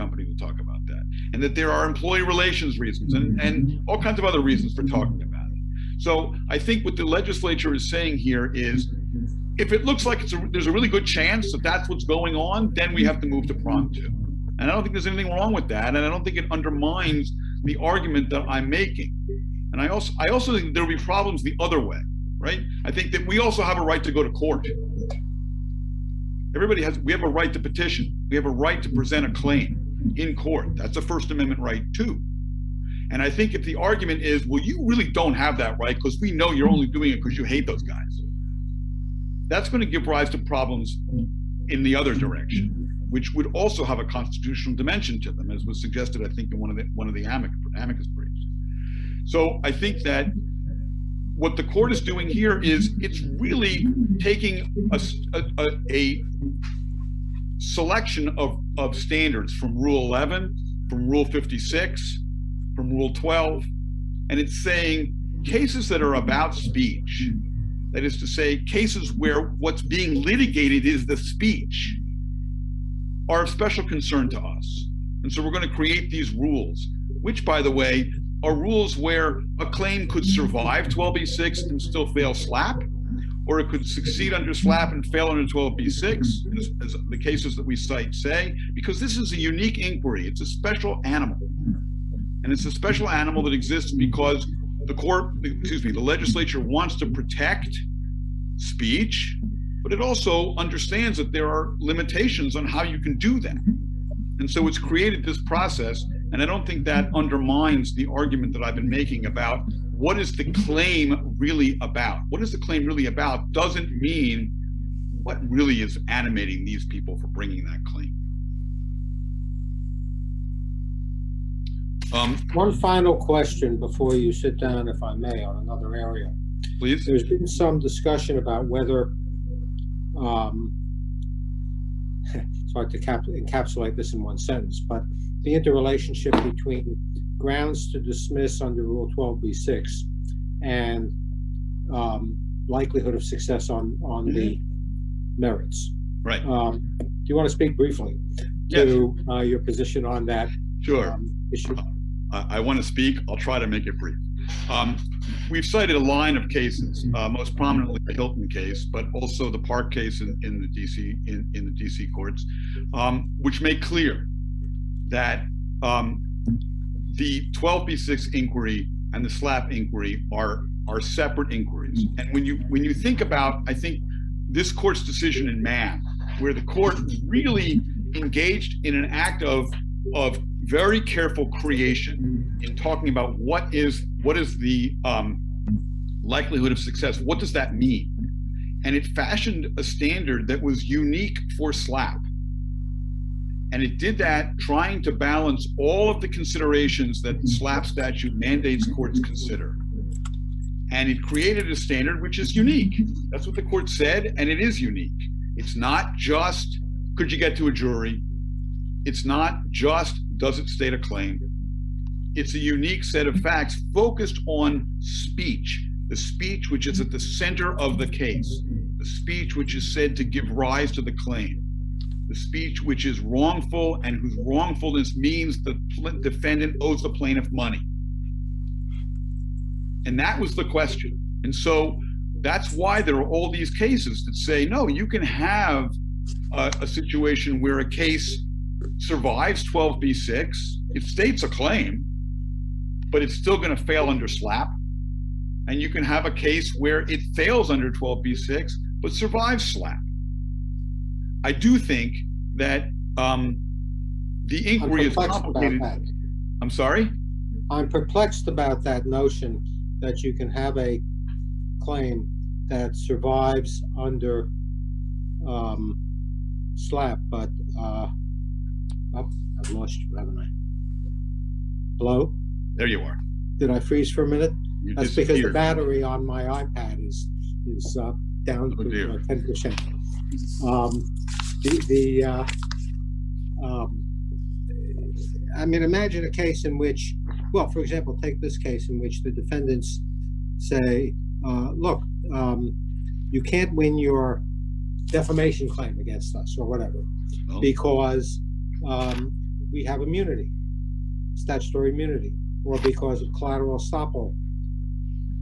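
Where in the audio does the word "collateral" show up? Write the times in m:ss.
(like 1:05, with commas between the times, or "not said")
5:03.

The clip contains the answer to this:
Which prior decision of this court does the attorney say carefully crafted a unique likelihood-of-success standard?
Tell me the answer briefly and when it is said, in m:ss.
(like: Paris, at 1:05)
Mann, at 2:55.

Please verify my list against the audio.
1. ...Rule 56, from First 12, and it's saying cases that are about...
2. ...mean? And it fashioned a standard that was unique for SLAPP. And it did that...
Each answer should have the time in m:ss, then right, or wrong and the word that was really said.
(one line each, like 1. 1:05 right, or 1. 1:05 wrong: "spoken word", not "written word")
1. 1:01 wrong: "Rule", not "First"
2. 3:07 right.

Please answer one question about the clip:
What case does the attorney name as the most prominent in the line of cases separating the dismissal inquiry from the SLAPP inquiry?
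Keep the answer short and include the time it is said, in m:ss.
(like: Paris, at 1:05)
Hilton, at 2:38.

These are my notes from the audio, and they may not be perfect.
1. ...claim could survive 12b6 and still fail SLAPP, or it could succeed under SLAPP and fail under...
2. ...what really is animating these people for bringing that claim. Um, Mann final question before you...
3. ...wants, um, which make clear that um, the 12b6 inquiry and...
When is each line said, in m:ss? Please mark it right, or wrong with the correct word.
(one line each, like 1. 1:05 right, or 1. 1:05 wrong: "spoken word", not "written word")
1. 1:19 right
2. 1:55 wrong: "One", not "Mann"
3. 2:42 wrong: "courts", not "wants".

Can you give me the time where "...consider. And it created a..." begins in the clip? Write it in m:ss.
3:19.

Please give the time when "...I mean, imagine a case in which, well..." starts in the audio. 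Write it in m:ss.
4:45.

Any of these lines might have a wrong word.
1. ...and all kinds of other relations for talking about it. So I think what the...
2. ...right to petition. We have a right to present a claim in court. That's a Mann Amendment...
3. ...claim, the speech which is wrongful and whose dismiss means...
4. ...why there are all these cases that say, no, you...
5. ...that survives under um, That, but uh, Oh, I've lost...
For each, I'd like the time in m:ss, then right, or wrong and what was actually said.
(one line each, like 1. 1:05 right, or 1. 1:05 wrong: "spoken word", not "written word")
1. 0:03 wrong: "reasons", not "relations"
2. 0:27 wrong: "First", not "Mann"
3. 3:41 wrong: "wrongfulness", not "dismiss"
4. 3:52 right
5. 4:22 wrong: "SLAPP", not "That".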